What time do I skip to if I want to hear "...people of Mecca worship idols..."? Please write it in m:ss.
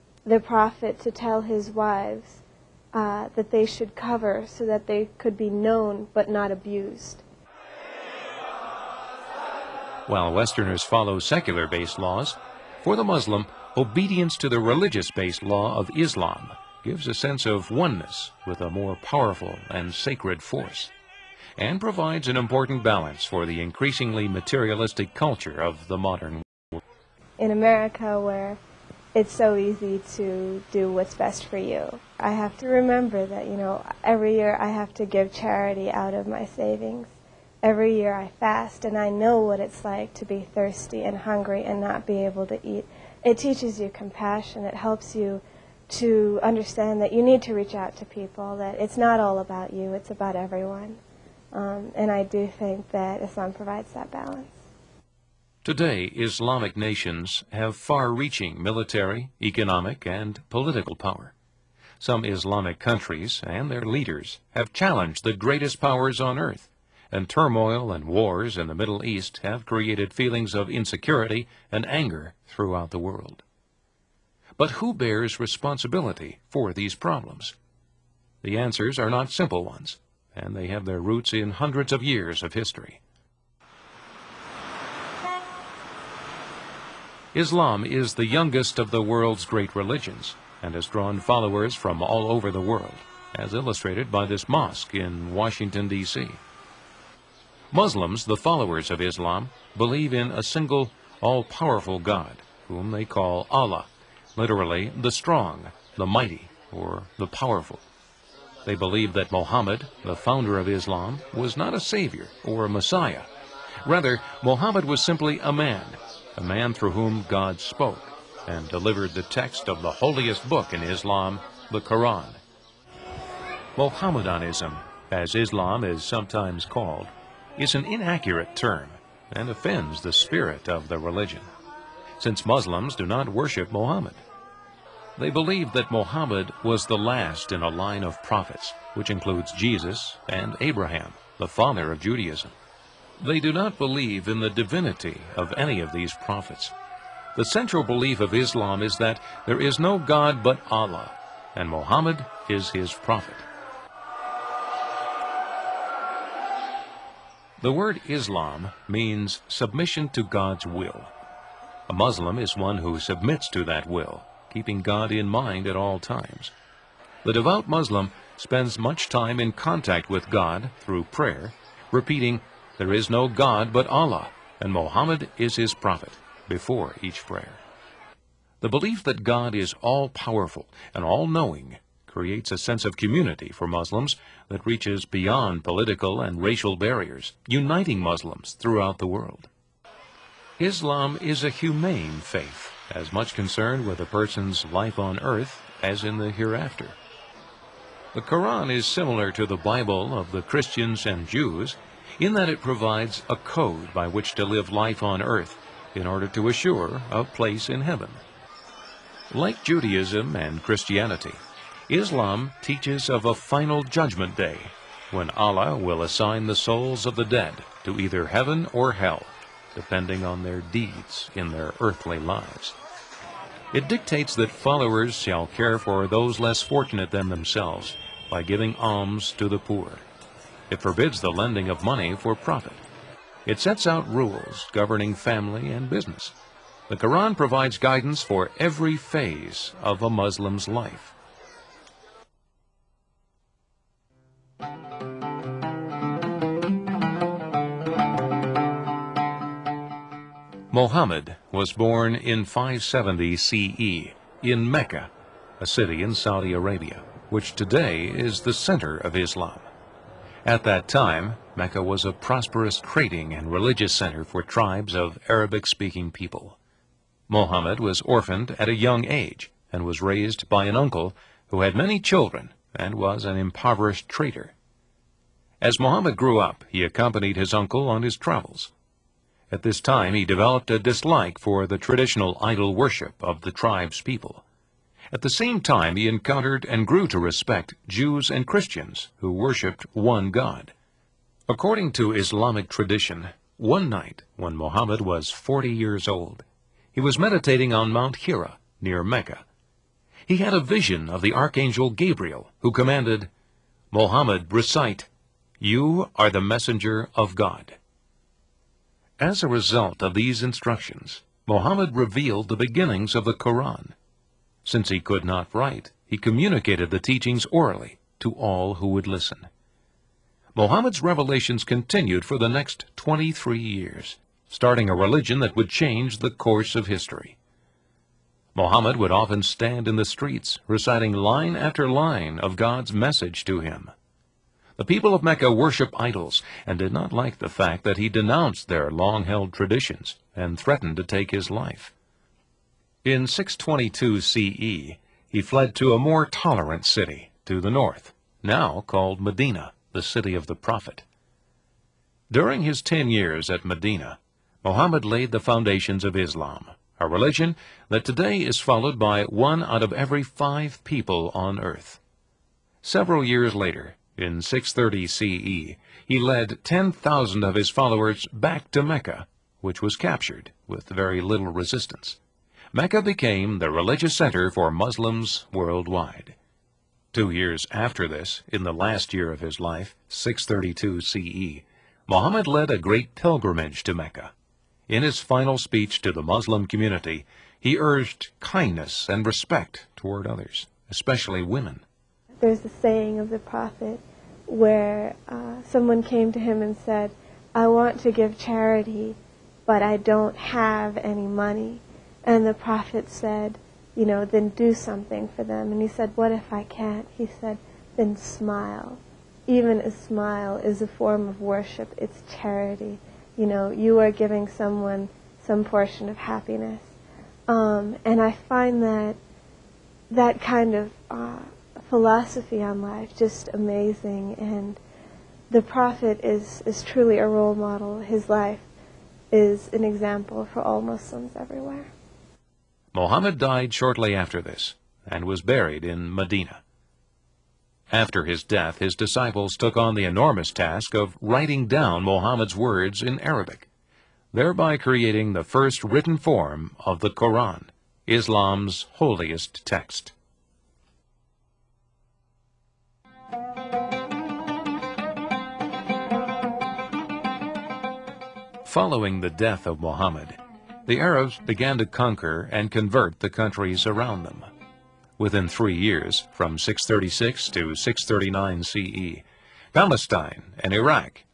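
5:34.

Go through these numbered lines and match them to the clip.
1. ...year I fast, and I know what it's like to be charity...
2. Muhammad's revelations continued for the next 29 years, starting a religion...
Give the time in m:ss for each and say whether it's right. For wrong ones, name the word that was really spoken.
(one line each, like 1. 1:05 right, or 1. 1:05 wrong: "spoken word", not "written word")
1. 0:37 wrong: "thirsty", not "charity"
2. 5:20 wrong: "23", not "29".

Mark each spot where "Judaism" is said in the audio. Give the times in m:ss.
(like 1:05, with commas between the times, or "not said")
2:21, 3:29.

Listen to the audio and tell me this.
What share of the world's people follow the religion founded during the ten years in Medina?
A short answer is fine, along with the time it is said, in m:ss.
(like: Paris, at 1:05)
One out of every five, at 5:59.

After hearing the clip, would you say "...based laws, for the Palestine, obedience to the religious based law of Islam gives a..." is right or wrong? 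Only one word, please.
wrong.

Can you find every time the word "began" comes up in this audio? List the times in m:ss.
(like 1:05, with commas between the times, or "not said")
7:41.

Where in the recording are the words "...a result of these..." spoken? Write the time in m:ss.
5:09.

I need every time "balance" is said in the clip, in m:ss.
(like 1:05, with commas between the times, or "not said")
0:22, 0:54.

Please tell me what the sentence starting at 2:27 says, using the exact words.
The central belief of Islam is that there is no God but Allah, and Muhammad is his prophet.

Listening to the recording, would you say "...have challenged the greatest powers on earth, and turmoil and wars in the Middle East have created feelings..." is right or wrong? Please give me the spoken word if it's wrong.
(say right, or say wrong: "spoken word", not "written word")
right.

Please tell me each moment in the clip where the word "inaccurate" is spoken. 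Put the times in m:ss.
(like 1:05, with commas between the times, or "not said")
2:07.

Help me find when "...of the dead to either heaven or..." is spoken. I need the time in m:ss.
3:37.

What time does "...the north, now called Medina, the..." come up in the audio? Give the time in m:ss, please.
5:47.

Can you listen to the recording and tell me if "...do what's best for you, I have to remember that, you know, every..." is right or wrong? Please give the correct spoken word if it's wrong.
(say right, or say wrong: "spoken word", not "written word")
right.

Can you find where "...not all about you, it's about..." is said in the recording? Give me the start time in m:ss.
0:48.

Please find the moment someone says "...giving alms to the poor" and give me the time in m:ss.
3:48.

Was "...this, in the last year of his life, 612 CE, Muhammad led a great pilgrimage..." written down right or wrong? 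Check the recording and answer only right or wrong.
wrong.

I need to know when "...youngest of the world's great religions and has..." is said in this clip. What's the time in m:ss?
1:28.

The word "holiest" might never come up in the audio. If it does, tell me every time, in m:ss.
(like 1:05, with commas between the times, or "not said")
1:59, 7:28.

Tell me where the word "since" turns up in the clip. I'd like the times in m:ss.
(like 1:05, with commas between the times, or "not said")
2:12, 5:14.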